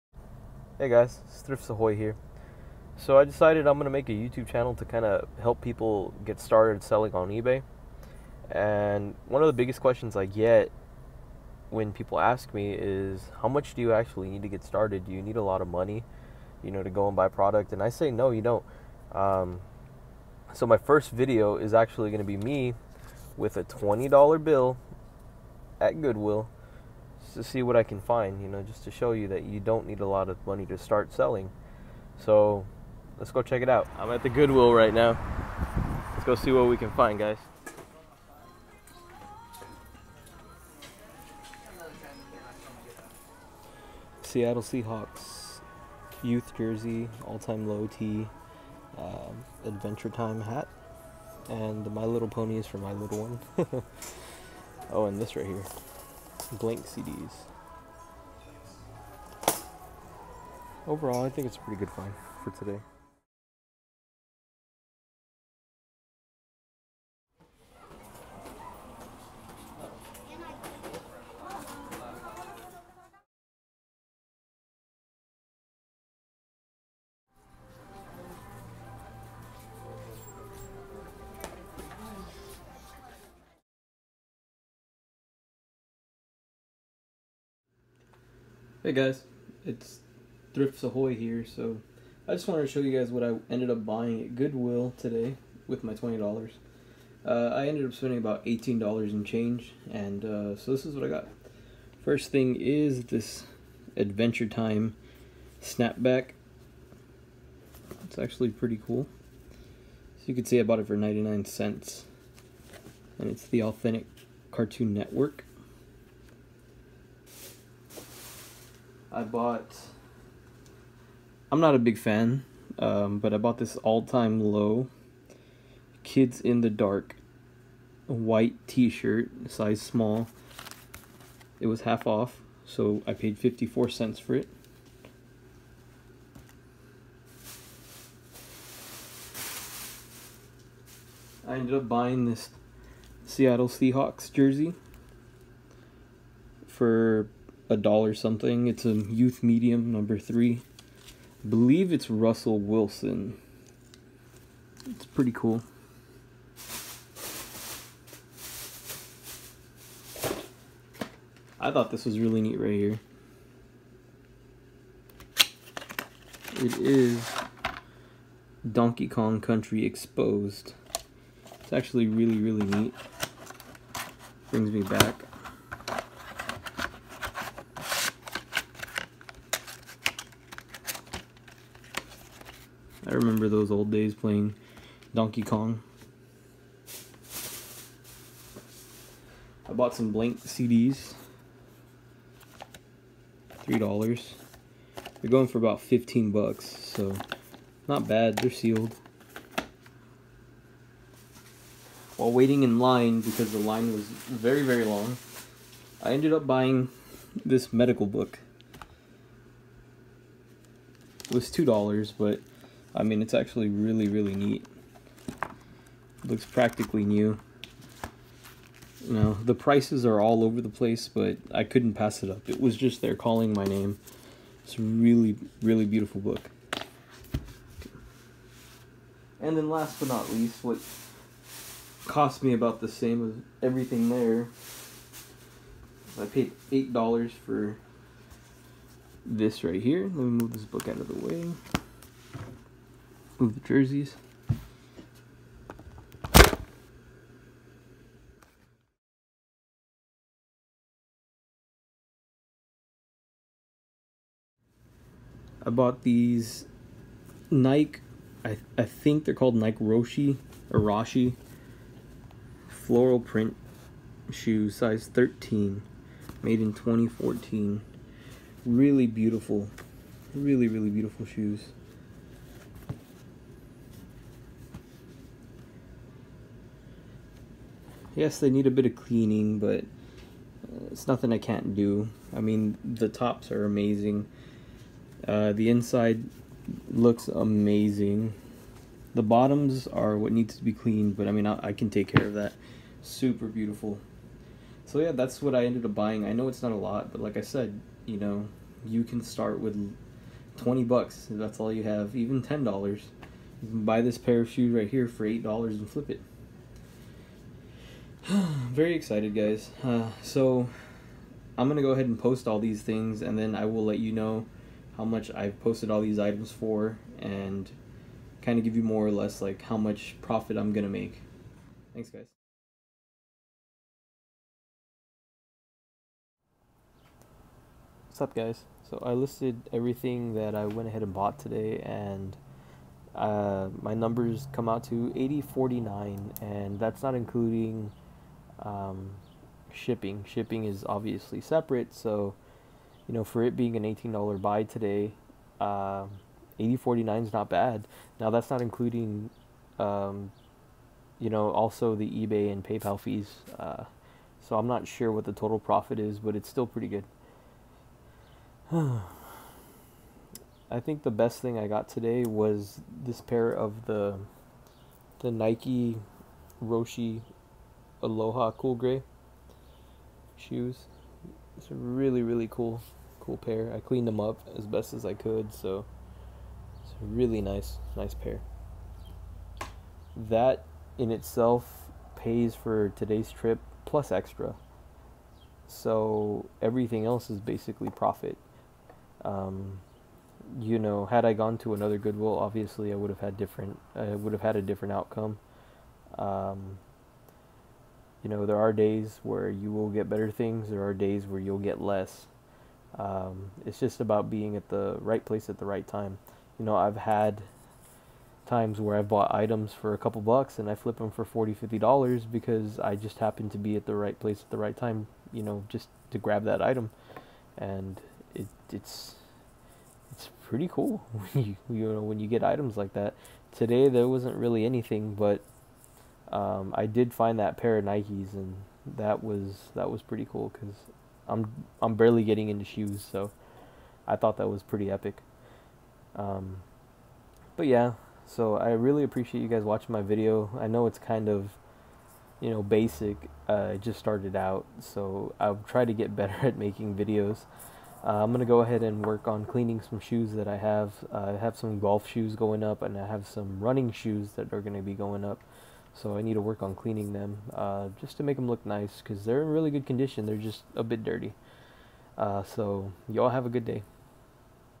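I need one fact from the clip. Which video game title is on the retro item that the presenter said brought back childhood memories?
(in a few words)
Donkey Kong Country Exposed.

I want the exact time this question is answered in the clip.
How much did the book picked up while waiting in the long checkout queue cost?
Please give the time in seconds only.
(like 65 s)
211 s.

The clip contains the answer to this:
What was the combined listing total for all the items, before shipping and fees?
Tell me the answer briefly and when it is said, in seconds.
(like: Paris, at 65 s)
$80.49, at 335 s.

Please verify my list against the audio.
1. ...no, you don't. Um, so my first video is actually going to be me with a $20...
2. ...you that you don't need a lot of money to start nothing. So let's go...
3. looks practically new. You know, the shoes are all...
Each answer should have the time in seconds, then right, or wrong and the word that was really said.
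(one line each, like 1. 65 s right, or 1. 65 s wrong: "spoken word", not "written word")
1. 18 s right
2. 29 s wrong: "selling", not "nothing"
3. 216 s wrong: "prices", not "shoes".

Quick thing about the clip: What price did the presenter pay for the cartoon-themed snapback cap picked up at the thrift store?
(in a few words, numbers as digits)
99 cents.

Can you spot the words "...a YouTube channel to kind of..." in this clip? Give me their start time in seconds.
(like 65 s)
4 s.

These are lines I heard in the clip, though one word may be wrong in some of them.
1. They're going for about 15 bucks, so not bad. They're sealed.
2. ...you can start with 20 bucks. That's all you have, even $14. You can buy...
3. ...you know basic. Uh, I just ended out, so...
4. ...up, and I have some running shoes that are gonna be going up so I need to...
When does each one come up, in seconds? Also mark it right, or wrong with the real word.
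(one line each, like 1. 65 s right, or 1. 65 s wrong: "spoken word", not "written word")
1. 195 s right
2. 298 s wrong: "10", not "14"
3. 442 s wrong: "started", not "ended"
4. 452 s right.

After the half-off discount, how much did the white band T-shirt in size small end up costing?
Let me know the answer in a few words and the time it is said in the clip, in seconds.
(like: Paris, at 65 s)
54 cents, at 133 s.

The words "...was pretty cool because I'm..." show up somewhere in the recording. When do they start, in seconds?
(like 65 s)
429 s.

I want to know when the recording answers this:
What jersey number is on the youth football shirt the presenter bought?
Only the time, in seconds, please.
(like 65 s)
149 s.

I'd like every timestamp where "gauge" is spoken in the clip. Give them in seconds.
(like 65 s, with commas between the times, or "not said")
not said.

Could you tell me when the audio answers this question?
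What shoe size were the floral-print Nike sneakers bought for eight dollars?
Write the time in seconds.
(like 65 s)
264 s.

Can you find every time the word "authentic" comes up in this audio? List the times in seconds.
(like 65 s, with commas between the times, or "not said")
113 s.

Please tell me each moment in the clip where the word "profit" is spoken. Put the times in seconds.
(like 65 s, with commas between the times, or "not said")
320 s, 355 s, 387 s.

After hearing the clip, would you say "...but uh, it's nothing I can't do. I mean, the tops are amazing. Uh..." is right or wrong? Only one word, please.
right.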